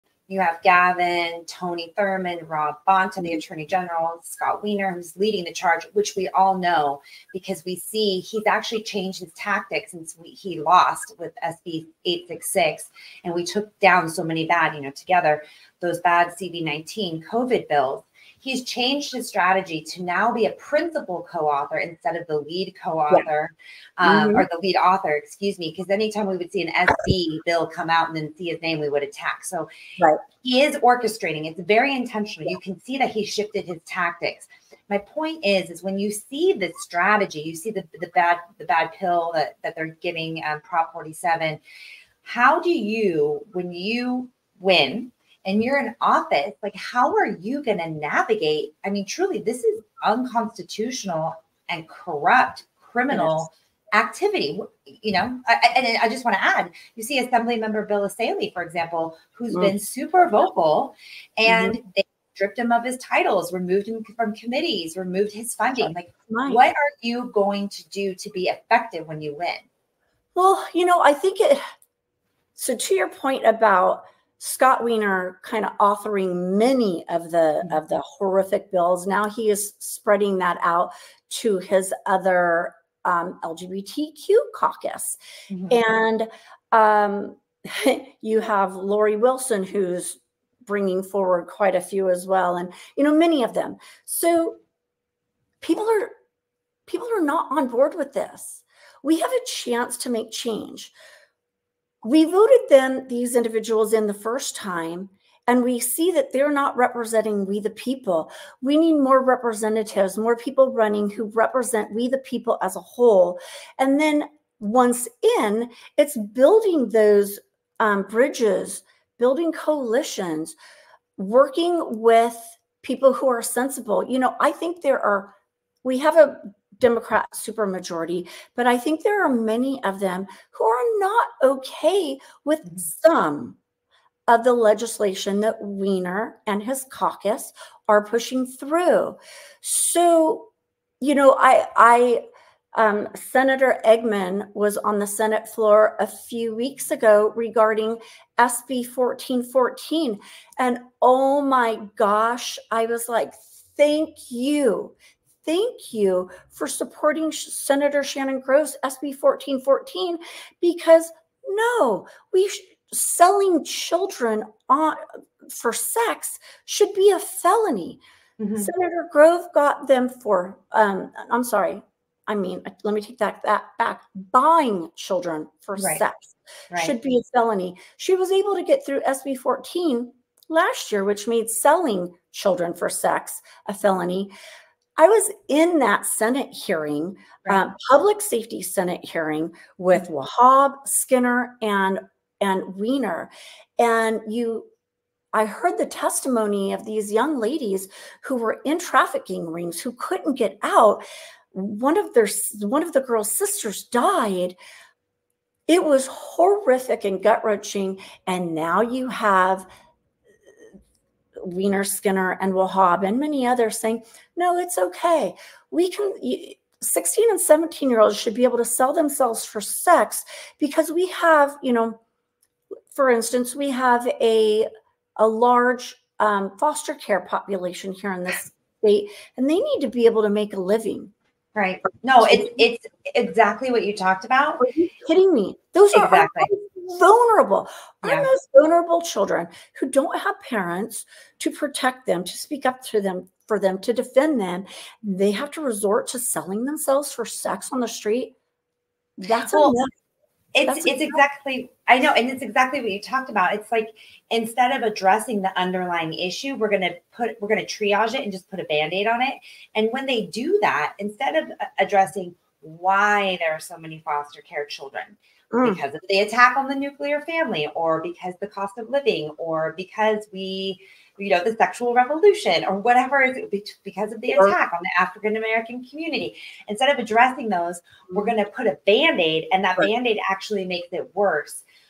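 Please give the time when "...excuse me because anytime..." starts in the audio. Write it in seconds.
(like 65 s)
25 s.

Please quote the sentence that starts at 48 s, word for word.
I mean, truly, this is unconstitutional and corrupt criminal yes.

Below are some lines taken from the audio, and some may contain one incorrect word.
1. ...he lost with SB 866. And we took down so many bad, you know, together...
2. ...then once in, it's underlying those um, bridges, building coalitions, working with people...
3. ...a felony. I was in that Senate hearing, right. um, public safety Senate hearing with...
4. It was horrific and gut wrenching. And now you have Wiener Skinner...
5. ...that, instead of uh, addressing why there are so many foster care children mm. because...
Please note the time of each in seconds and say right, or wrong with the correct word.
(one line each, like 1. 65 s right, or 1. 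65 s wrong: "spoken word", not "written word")
1. 10 s right
2. 113 s wrong: "building", not "underlying"
3. 183 s right
4. 205 s right
5. 260 s right.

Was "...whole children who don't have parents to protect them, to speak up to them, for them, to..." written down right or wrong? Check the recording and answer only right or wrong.
wrong.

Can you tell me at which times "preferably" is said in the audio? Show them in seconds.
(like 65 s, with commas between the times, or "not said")
not said.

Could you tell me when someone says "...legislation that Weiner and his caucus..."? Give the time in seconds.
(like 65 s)
134 s.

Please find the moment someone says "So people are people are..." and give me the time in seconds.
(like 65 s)
94 s.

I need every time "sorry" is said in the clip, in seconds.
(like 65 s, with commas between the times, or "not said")
171 s.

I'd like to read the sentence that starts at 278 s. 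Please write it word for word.
going to put a band-aid and that right.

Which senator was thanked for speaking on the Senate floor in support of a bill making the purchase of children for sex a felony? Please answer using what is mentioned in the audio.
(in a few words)
Senator Eggman.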